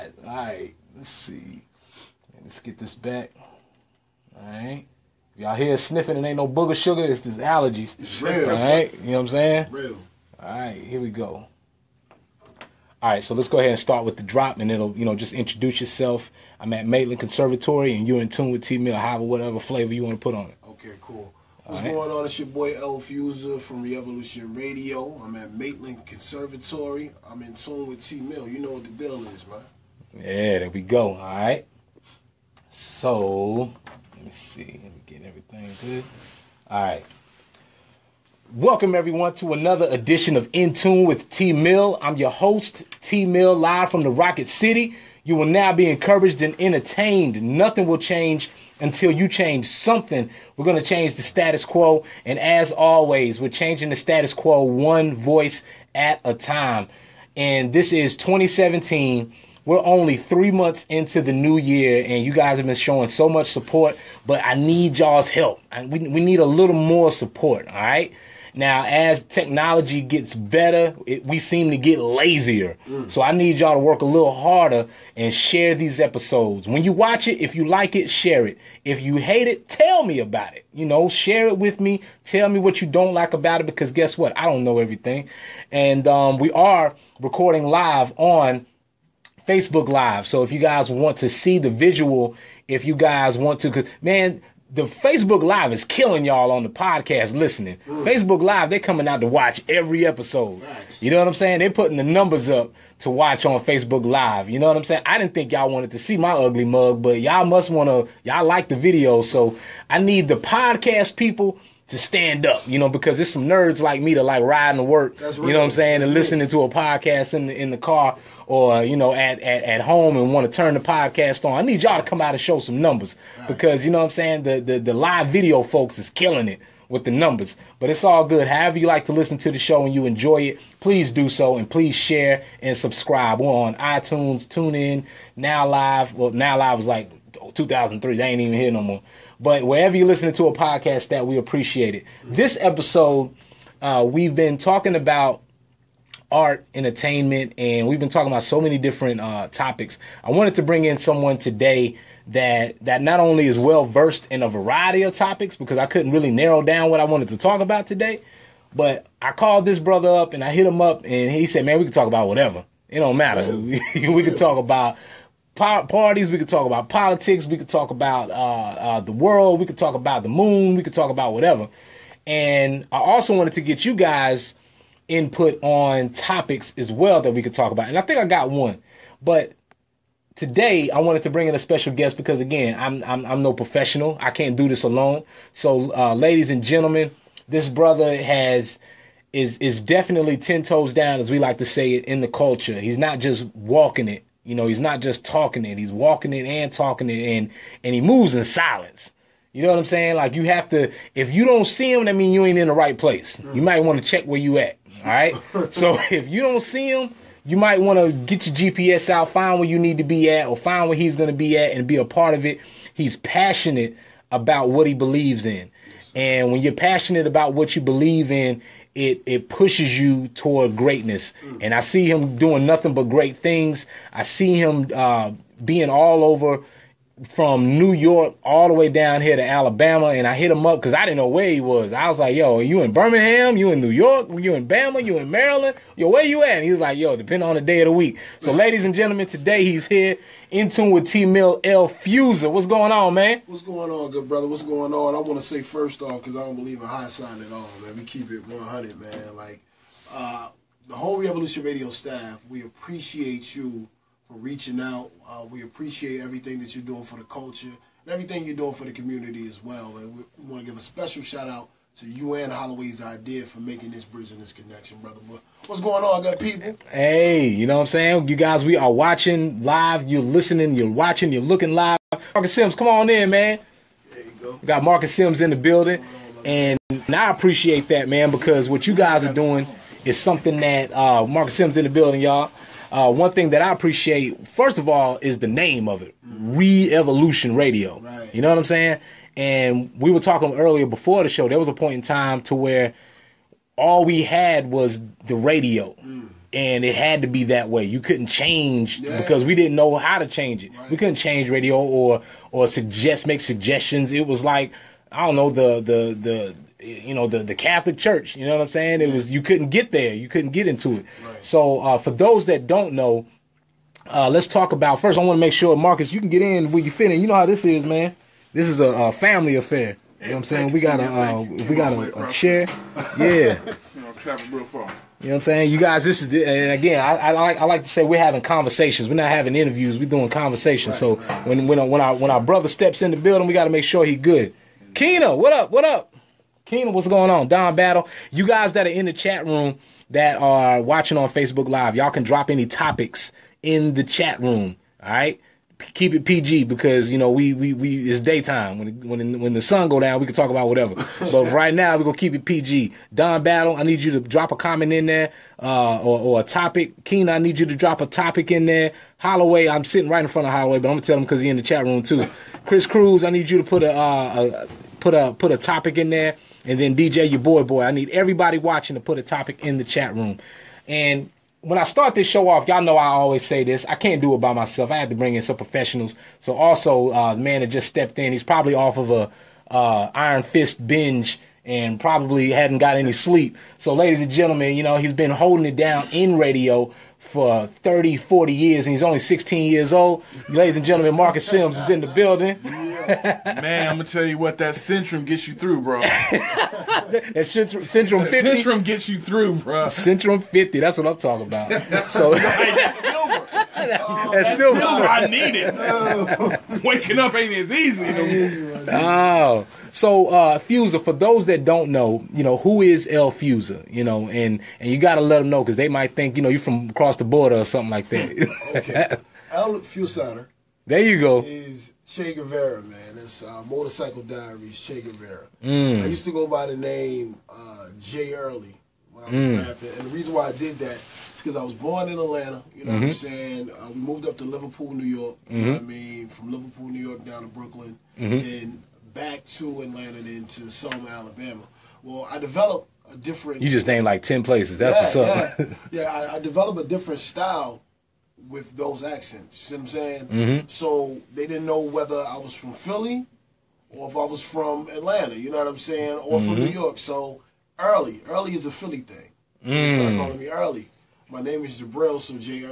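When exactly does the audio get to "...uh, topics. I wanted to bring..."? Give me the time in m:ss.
2:29.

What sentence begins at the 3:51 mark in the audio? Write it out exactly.
I was like, "Yo, are you in Birmingham?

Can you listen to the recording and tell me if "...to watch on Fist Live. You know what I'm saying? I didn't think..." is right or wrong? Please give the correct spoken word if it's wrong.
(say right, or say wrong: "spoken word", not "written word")
wrong: "Facebook", not "Fist".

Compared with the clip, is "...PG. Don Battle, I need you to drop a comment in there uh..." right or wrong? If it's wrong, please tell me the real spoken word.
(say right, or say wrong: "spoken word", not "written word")
right.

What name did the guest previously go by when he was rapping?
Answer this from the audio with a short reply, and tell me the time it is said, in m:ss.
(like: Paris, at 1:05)
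Jay Early, at 7:07.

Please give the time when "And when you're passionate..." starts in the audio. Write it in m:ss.
3:36.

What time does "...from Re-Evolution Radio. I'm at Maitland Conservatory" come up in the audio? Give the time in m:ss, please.
0:23.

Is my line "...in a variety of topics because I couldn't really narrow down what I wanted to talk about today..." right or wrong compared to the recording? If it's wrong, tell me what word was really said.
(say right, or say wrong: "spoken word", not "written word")
right.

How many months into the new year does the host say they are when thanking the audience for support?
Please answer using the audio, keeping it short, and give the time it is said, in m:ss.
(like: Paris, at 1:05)
3, at 1:00.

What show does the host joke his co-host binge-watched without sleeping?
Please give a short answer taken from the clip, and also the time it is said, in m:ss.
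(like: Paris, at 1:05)
Iron Fist, at 6:20.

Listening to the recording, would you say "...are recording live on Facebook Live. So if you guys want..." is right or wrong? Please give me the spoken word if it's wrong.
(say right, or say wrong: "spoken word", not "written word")
right.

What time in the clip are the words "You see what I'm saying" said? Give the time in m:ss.
7:29.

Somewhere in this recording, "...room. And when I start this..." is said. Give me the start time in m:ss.
6:10.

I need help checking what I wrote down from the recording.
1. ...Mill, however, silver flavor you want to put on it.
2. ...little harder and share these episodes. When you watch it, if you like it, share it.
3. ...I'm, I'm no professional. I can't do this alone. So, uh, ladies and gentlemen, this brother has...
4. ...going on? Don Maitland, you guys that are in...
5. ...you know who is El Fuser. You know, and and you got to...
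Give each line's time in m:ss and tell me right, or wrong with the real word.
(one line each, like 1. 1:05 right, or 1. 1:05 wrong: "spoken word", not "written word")
1. 0:18 wrong: "whatever", not "silver"
2. 1:14 right
3. 3:03 right
4. 5:37 wrong: "Battle", not "Maitland"
5. 6:52 right.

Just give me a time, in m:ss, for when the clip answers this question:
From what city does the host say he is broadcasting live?
0:44.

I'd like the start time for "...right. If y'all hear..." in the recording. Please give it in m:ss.
0:04.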